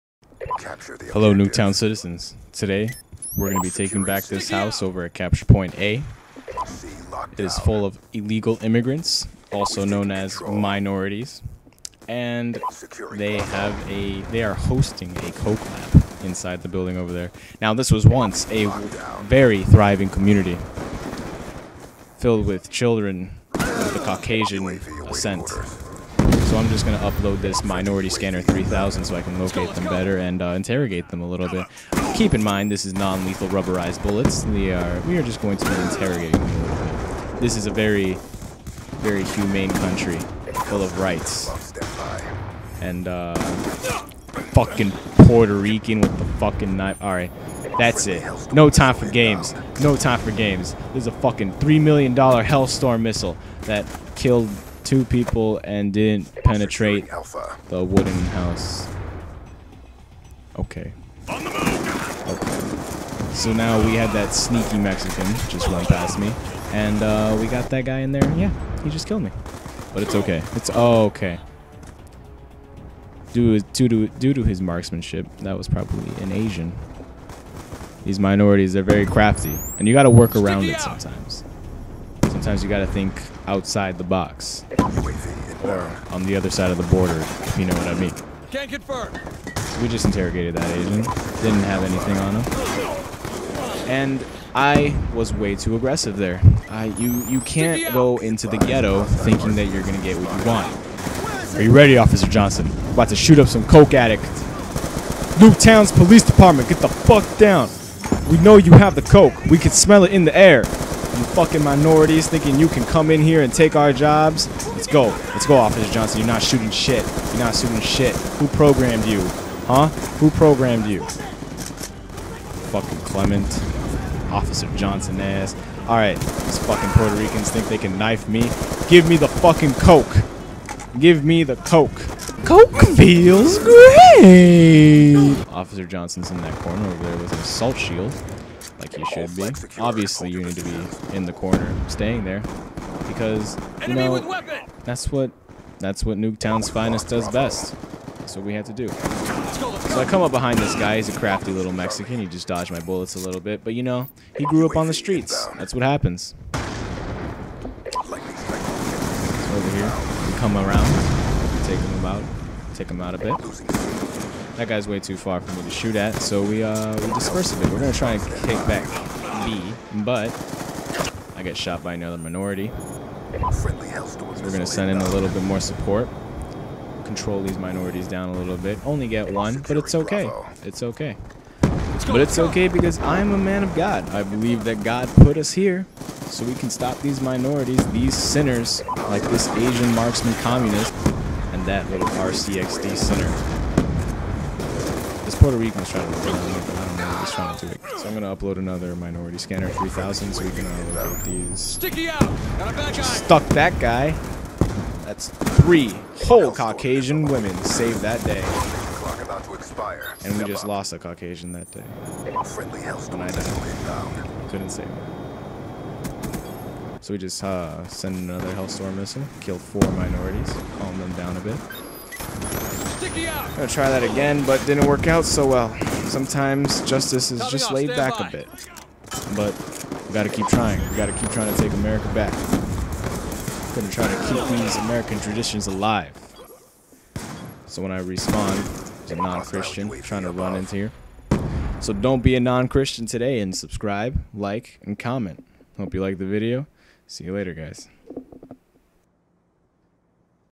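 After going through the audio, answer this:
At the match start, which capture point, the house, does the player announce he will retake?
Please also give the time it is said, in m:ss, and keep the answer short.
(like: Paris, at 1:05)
Capture Point A, at 0:05.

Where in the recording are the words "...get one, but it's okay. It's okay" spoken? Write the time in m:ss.
2:59.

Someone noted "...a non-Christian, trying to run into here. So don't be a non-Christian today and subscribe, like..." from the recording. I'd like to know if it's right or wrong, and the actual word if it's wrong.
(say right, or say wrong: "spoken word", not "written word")
right.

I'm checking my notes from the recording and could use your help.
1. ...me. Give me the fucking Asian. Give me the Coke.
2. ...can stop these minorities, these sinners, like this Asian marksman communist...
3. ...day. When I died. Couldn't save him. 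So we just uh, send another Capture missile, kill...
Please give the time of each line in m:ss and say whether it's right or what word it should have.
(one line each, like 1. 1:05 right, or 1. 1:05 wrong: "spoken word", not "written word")
1. 2:08 wrong: "Coke", not "Asian"
2. 3:06 right
3. 3:31 wrong: "Hellstorm", not "Capture".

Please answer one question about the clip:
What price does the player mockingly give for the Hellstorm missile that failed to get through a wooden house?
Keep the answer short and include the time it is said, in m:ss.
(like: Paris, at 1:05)
$3 million, at 0:51.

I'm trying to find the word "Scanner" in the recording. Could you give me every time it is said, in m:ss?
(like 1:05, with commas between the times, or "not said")
0:28, 3:19.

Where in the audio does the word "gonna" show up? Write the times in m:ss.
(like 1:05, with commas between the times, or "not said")
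2:47, 2:54, 3:18, 3:43, 3:53.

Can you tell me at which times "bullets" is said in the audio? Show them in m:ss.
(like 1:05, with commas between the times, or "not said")
0:34, 2:32.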